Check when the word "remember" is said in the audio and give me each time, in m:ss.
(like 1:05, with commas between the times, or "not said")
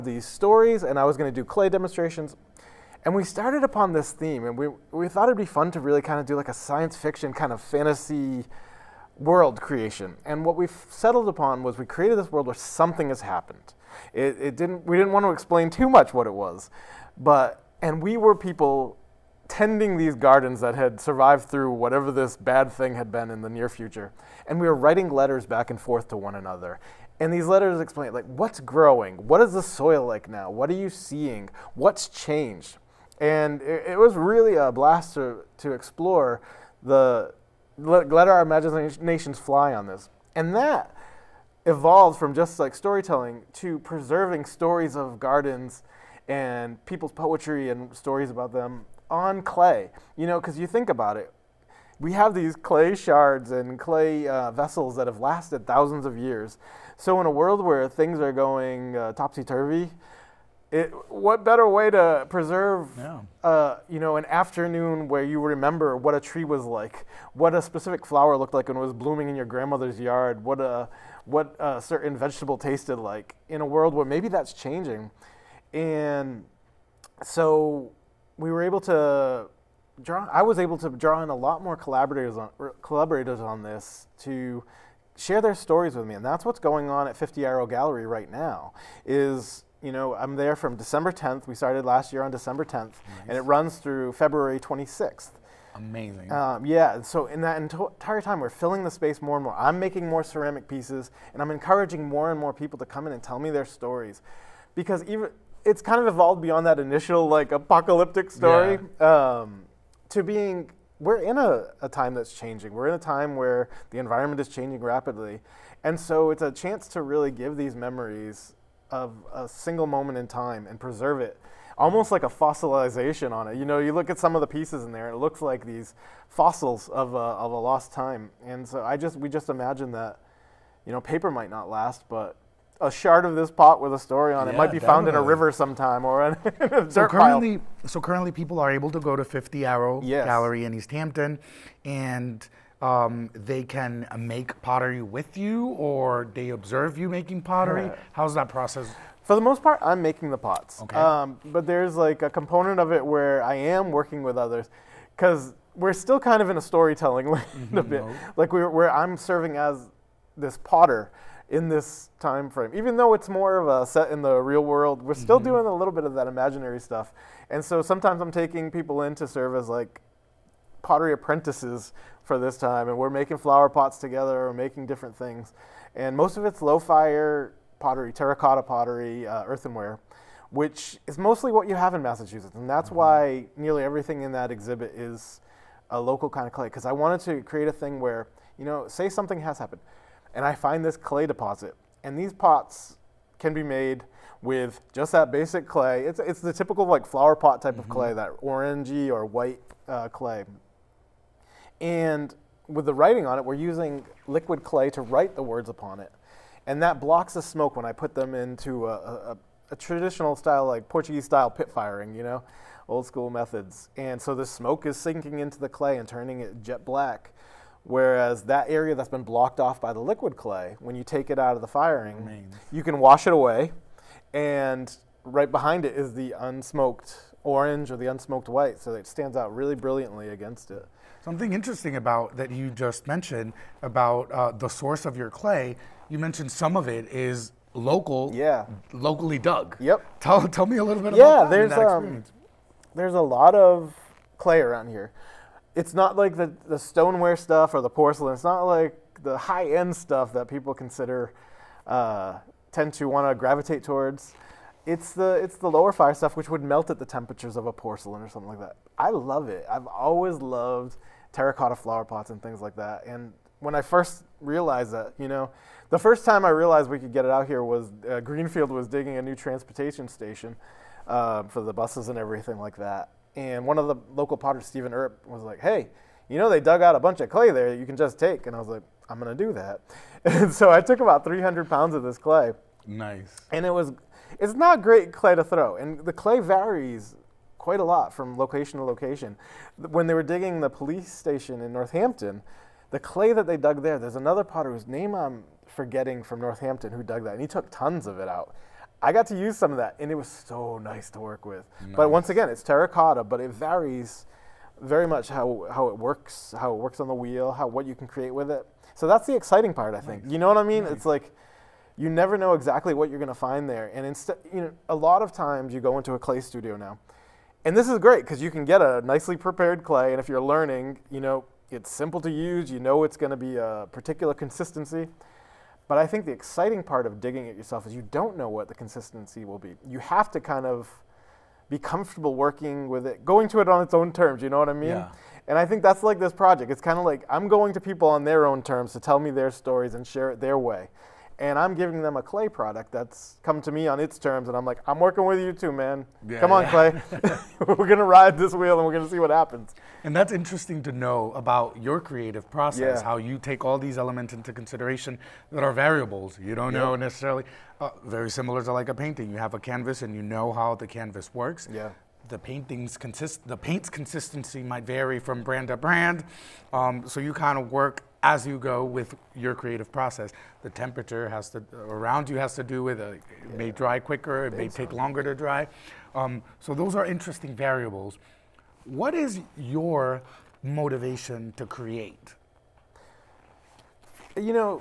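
1:05.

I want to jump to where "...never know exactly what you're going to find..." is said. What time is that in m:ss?
5:12.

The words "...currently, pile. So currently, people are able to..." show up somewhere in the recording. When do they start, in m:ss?
2:17.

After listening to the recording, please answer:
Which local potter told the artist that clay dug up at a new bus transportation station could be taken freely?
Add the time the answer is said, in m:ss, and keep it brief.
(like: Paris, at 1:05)
Stephen Earp, at 4:34.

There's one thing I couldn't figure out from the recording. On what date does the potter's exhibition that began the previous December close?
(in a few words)
February 26th.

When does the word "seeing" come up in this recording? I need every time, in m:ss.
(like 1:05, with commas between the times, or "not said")
0:30.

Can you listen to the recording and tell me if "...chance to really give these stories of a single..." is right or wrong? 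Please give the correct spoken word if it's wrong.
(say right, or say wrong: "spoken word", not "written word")
wrong: "memories", not "stories".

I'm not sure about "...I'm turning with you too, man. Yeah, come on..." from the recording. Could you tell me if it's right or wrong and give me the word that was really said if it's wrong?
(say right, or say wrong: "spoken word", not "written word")
wrong: "working", not "turning".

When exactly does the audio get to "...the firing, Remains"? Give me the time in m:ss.
3:41.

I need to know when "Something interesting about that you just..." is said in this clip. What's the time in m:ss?
3:51.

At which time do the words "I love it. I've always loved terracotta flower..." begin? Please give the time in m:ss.
4:18.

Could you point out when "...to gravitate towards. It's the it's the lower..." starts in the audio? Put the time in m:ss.
4:13.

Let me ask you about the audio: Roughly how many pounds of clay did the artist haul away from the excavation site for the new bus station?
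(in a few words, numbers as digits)
300 pounds.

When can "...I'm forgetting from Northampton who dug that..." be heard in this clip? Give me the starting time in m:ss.
4:55.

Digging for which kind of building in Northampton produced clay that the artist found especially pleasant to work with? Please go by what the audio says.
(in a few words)
police station.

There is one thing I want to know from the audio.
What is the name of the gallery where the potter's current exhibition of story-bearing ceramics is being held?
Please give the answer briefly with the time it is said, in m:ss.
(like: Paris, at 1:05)
50 Arrow Gallery, at 1:27.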